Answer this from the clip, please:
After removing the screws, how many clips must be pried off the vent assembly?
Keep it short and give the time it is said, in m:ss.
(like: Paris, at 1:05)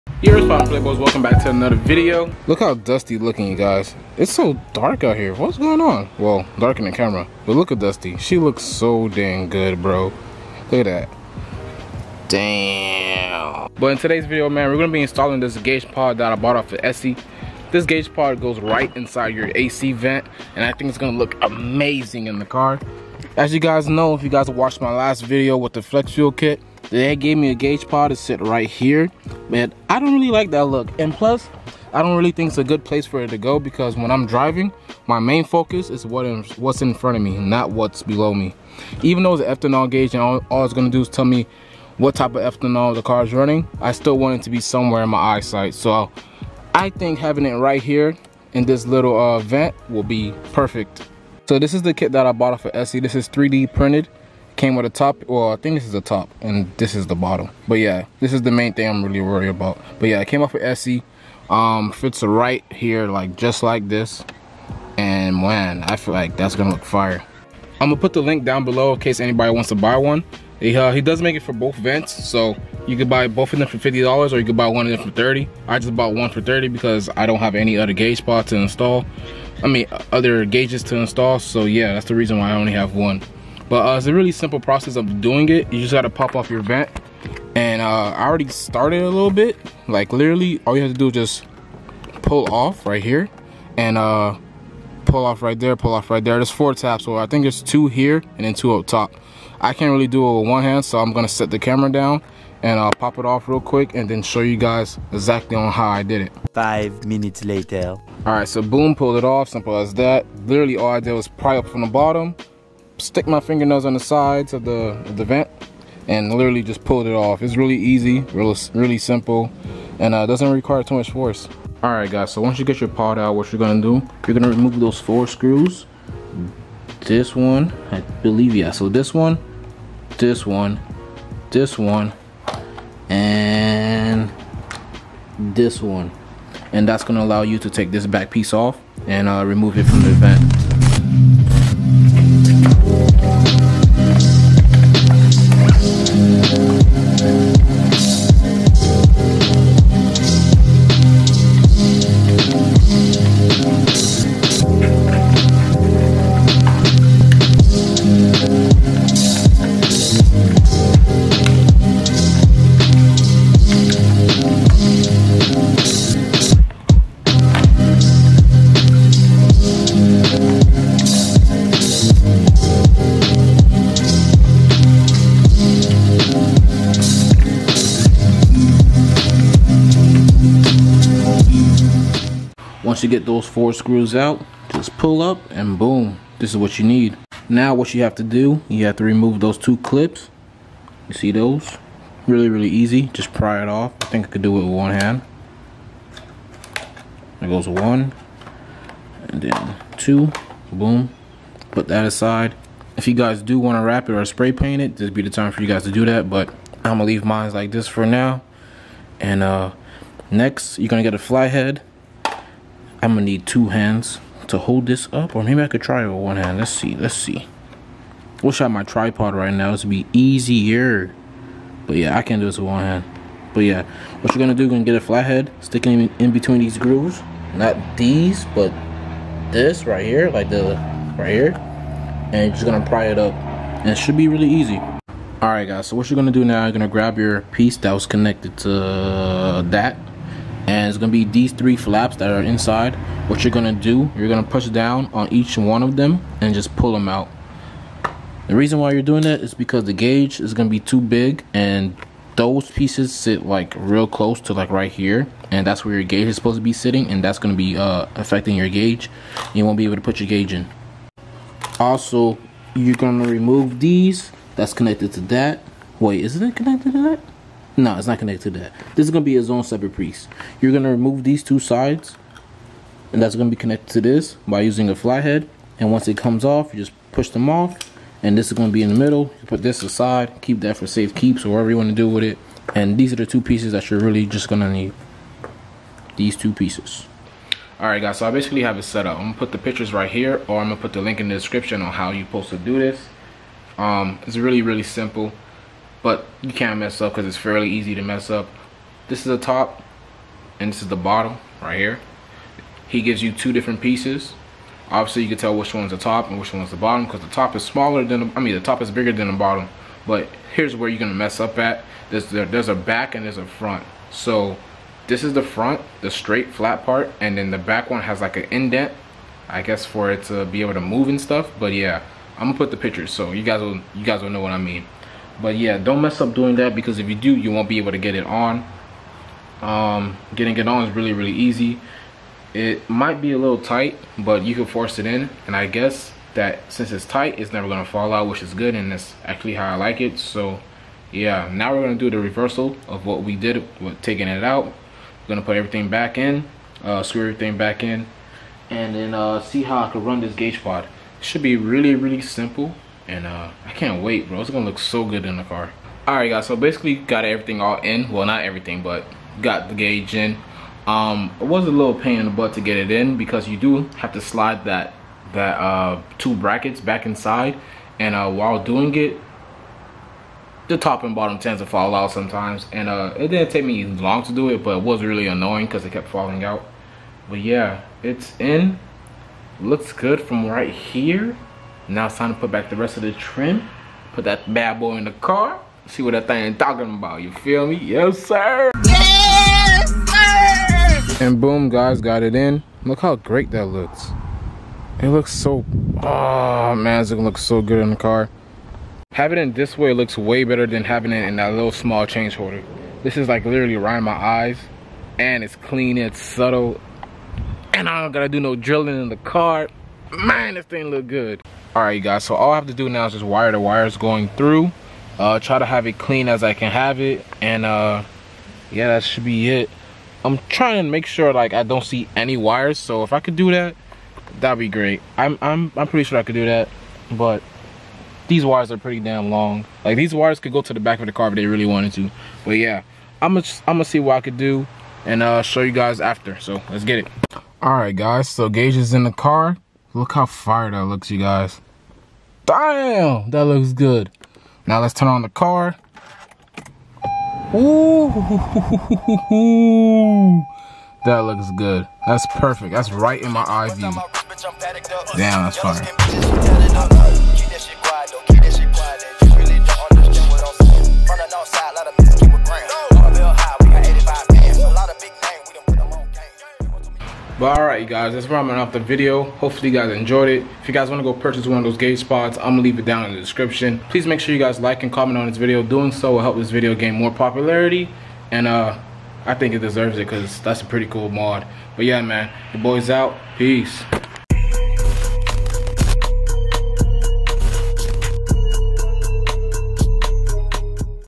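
2, at 3:09.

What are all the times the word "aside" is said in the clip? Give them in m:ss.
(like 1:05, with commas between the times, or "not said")
3:22, 4:39.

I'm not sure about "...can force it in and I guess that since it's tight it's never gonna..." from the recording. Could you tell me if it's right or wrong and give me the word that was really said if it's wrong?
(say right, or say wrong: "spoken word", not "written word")
right.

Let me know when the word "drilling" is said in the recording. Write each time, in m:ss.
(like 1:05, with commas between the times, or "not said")
6:48.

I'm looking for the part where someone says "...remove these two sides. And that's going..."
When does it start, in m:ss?
4:30.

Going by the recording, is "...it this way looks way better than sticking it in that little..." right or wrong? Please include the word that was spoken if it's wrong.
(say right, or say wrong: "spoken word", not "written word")
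wrong: "having", not "sticking".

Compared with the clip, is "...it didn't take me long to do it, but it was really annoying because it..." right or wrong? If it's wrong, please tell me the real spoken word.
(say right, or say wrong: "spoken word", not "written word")
right.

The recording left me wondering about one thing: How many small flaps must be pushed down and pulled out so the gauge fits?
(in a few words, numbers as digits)
3.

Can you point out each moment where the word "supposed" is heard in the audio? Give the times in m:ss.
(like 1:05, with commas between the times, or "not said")
4:16, 4:52.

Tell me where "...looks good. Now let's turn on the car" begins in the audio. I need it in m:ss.
7:23.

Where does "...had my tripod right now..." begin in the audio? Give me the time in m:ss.
3:38.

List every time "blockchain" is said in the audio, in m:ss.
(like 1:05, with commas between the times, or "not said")
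not said.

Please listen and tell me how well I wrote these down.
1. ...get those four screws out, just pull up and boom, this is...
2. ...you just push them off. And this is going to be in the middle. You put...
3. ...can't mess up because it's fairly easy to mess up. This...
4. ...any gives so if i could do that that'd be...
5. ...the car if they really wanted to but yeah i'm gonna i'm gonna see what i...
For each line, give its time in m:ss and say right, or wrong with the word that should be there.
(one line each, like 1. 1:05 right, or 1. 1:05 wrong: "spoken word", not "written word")
1. 3:03 right
2. 4:36 right
3. 4:56 right
4. 7:02 wrong: "wires", not "gives"
5. 7:11 right.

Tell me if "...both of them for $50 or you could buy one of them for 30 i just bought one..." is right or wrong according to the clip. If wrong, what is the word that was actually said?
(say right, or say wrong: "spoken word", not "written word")
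right.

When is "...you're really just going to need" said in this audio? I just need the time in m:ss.
4:43.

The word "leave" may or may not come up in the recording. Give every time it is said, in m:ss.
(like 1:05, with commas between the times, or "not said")
3:27, 7:52.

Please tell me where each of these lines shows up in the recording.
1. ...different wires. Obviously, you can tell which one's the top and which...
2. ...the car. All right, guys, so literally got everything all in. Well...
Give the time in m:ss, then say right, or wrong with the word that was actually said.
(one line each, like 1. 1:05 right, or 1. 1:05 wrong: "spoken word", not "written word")
1. 5:03 wrong: "pieces", not "wires"
2. 5:55 wrong: "basically", not "literally".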